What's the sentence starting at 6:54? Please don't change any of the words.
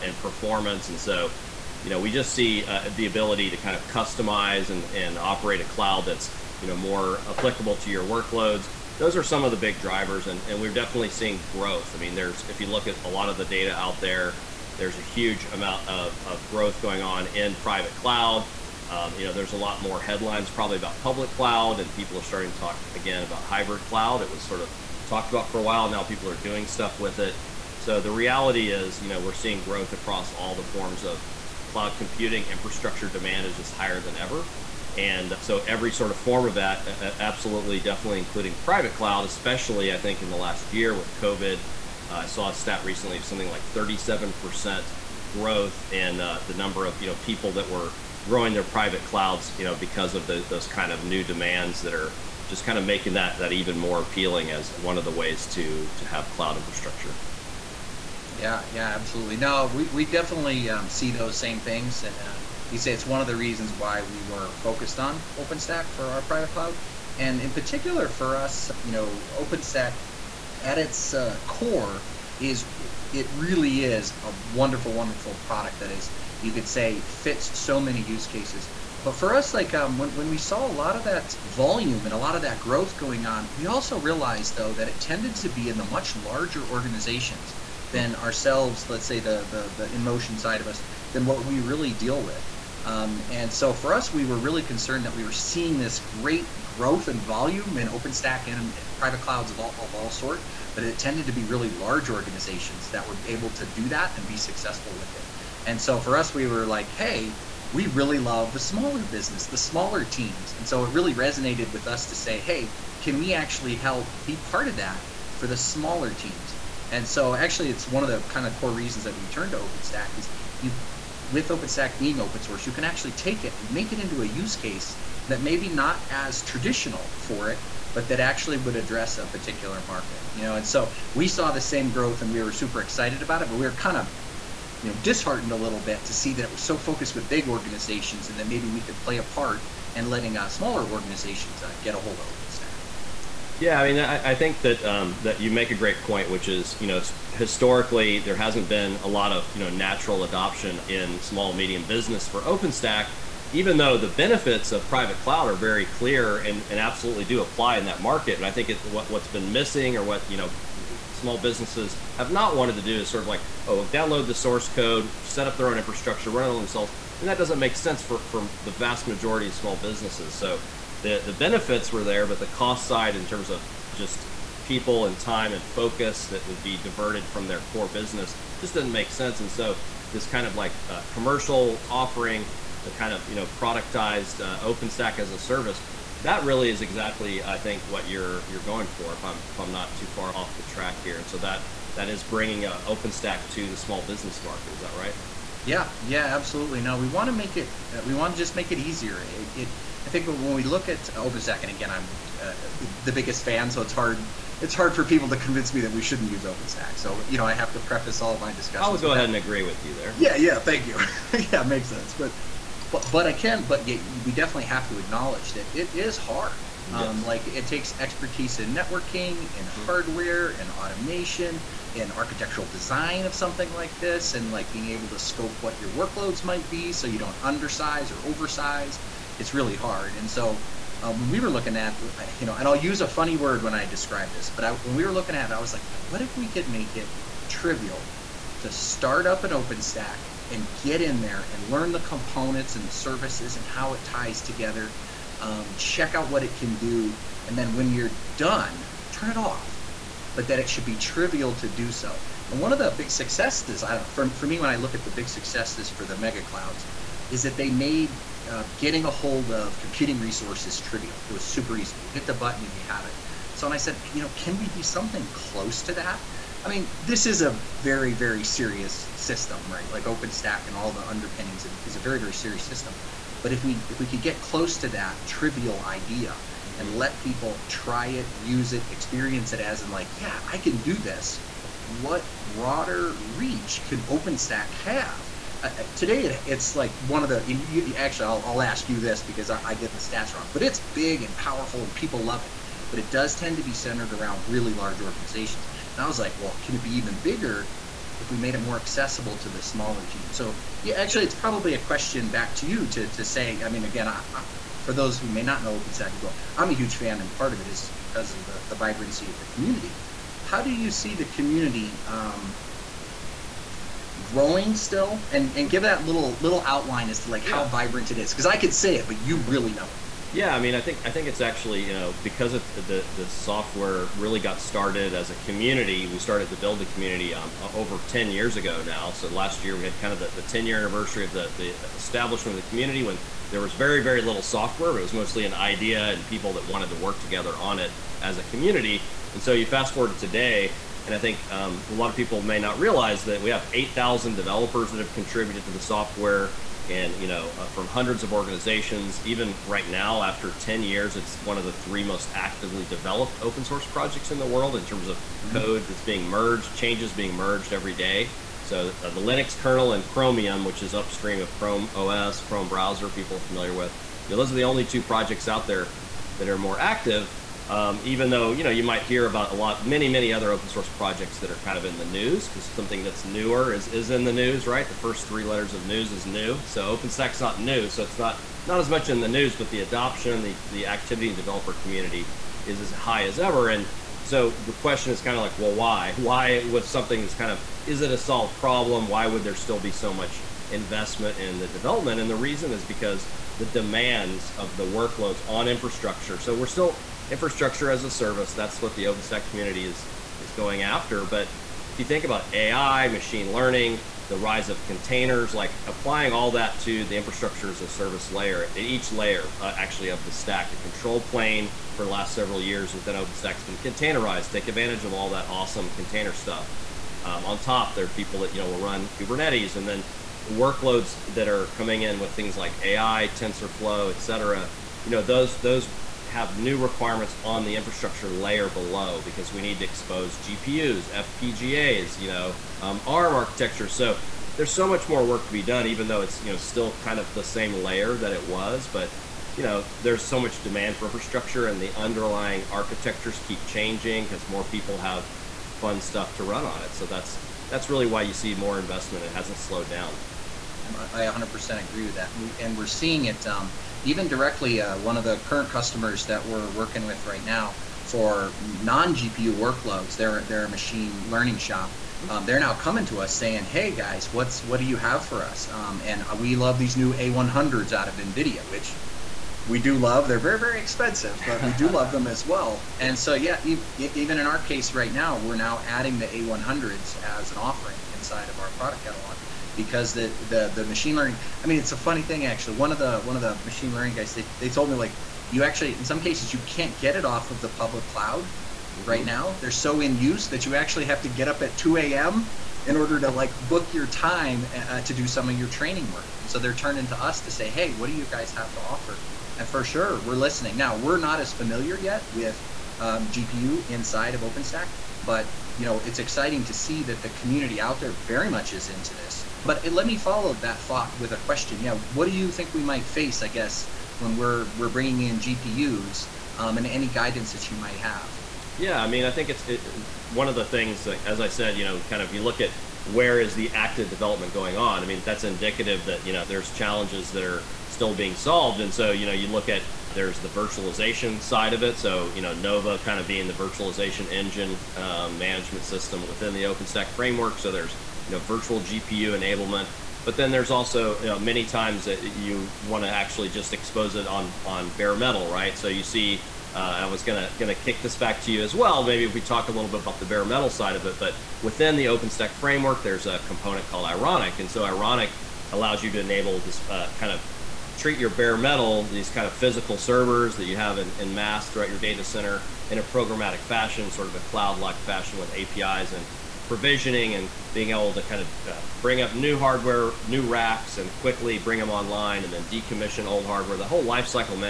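Take advantage of all that awesome container stuff.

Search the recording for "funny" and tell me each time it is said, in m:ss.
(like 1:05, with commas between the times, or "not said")
3:53, 8:01.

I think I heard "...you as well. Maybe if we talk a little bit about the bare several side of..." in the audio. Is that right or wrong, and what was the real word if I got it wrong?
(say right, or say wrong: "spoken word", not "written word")
wrong: "metal", not "several".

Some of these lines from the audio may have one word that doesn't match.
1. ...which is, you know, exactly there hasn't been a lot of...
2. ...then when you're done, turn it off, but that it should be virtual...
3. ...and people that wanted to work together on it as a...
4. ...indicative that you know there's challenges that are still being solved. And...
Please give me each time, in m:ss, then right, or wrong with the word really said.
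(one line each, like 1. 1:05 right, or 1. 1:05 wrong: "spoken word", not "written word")
1. 2:26 wrong: "historically", not "exactly"
2. 4:07 wrong: "trivial", not "virtual"
3. 5:36 right
4. 8:45 right.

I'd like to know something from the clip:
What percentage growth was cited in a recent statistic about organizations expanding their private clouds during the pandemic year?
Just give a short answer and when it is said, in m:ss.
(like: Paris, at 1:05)
37%, at 0:43.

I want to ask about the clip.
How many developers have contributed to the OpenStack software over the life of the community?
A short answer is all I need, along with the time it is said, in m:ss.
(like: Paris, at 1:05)
8000, at 5:43.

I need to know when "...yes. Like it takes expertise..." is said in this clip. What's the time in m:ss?
3:37.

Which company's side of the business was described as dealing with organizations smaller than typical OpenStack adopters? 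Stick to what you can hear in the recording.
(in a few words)
InMotion.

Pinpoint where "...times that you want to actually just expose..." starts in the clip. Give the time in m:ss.
9:01.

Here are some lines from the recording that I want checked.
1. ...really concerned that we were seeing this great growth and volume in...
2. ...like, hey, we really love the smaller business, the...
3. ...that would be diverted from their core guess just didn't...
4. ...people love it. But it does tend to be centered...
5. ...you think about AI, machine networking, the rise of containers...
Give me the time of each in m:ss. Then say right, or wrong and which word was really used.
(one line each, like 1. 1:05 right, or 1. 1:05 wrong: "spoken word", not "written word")
1. 1:34 right
2. 1:46 right
3. 2:56 wrong: "business", not "guess"
4. 4:51 right
5. 6:41 wrong: "learning", not "networking".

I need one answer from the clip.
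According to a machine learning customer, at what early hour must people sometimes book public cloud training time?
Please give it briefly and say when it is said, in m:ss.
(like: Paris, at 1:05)
2 a.m., at 8:11.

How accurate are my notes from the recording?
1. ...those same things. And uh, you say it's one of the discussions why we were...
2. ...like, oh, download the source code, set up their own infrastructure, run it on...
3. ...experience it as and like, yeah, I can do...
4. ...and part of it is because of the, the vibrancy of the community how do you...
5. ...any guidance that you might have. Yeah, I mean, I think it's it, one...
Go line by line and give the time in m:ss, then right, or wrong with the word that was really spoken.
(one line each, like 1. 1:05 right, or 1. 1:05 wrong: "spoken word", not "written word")
1. 1:01 wrong: "reasons", not "discussions"
2. 2:43 right
3. 4:38 right
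4. 5:07 right
5. 8:36 right.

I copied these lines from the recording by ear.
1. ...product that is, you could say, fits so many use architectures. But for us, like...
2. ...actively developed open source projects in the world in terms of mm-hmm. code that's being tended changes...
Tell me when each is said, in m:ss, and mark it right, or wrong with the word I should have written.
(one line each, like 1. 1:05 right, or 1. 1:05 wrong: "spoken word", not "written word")
1. 1:15 wrong: "cases", not "architectures"
2. 5:52 wrong: "merged", not "tended".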